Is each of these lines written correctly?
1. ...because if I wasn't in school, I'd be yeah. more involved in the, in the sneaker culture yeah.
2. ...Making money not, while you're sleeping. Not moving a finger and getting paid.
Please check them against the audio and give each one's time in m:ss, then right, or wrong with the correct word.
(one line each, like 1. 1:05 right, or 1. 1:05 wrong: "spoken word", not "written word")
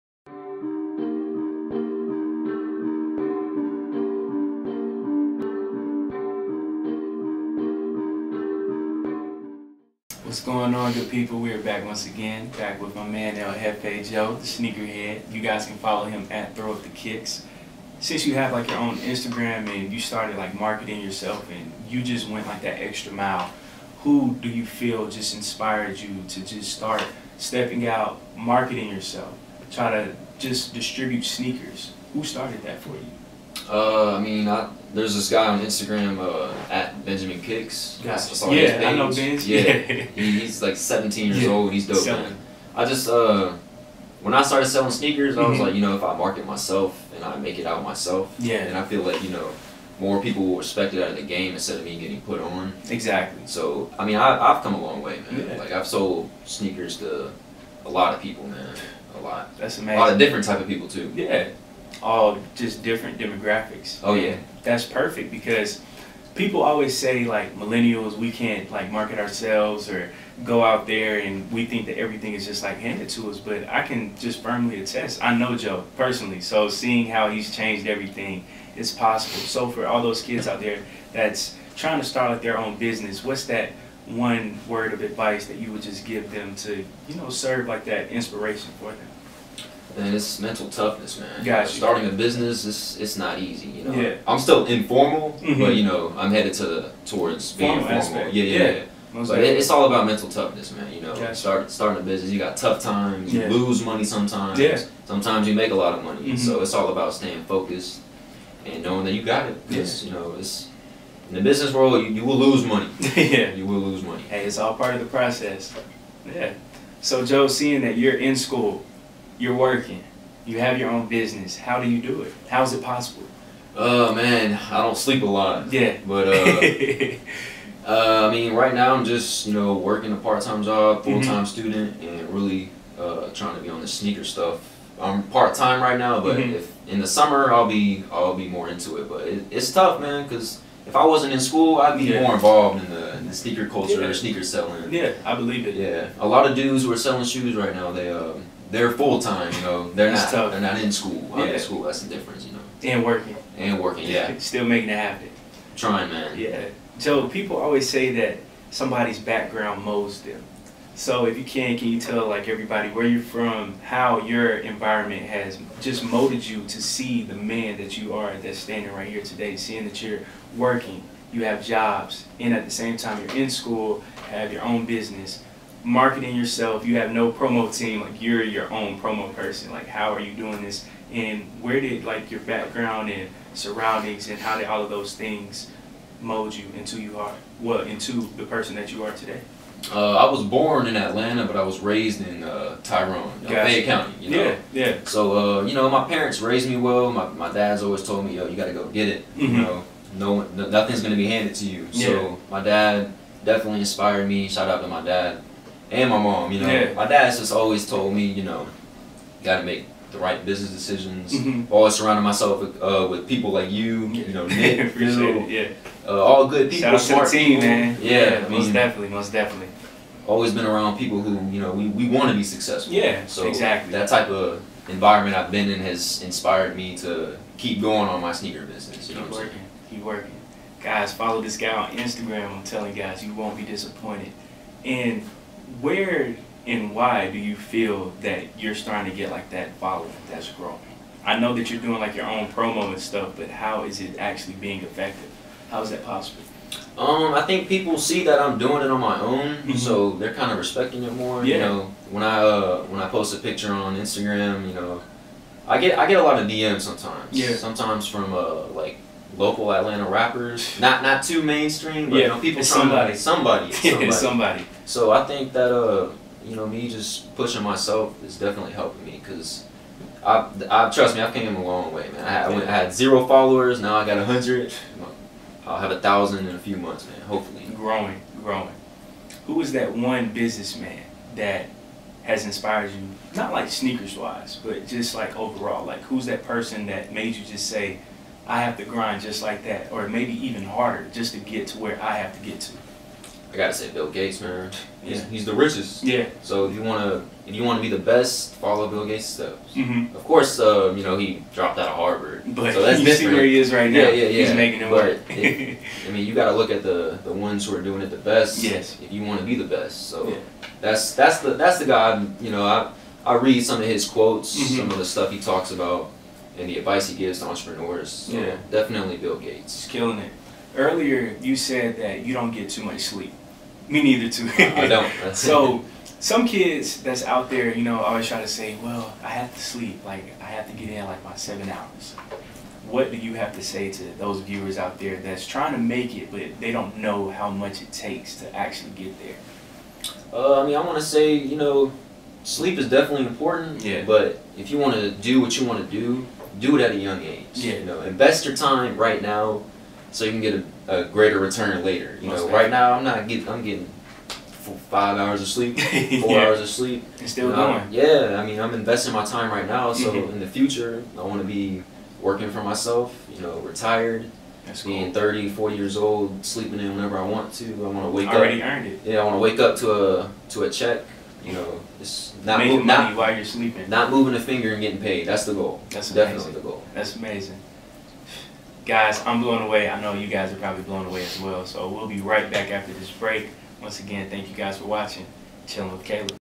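1. 2:20 right
2. 6:12 right.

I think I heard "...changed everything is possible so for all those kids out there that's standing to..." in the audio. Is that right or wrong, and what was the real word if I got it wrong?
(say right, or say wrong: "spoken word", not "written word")
wrong: "trying", not "standing".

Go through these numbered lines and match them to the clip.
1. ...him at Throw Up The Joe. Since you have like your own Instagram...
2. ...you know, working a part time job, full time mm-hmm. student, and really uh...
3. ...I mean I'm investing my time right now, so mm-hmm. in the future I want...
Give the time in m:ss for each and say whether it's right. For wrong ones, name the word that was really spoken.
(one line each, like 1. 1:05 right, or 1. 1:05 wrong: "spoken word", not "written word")
1. 0:16 wrong: "Kicks", not "Joe"
2. 2:09 right
3. 5:58 right.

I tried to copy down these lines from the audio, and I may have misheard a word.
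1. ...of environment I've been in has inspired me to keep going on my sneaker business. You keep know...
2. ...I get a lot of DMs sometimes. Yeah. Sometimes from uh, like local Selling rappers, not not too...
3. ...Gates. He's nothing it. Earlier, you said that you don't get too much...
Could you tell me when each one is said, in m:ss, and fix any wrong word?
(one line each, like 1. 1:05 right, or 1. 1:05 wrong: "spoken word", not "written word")
1. 3:44 right
2. 4:15 wrong: "Atlanta", not "Selling"
3. 5:19 wrong: "killing", not "nothing".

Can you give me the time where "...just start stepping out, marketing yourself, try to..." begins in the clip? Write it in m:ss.
0:26.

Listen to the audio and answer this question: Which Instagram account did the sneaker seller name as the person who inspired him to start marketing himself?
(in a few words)
Benjamin Kicks.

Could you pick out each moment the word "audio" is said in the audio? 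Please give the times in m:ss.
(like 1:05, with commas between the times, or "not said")
not said.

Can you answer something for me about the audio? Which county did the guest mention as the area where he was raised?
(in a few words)
Fayette County.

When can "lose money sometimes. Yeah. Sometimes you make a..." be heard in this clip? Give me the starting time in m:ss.
1:43.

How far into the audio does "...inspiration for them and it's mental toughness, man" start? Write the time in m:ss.
1:28.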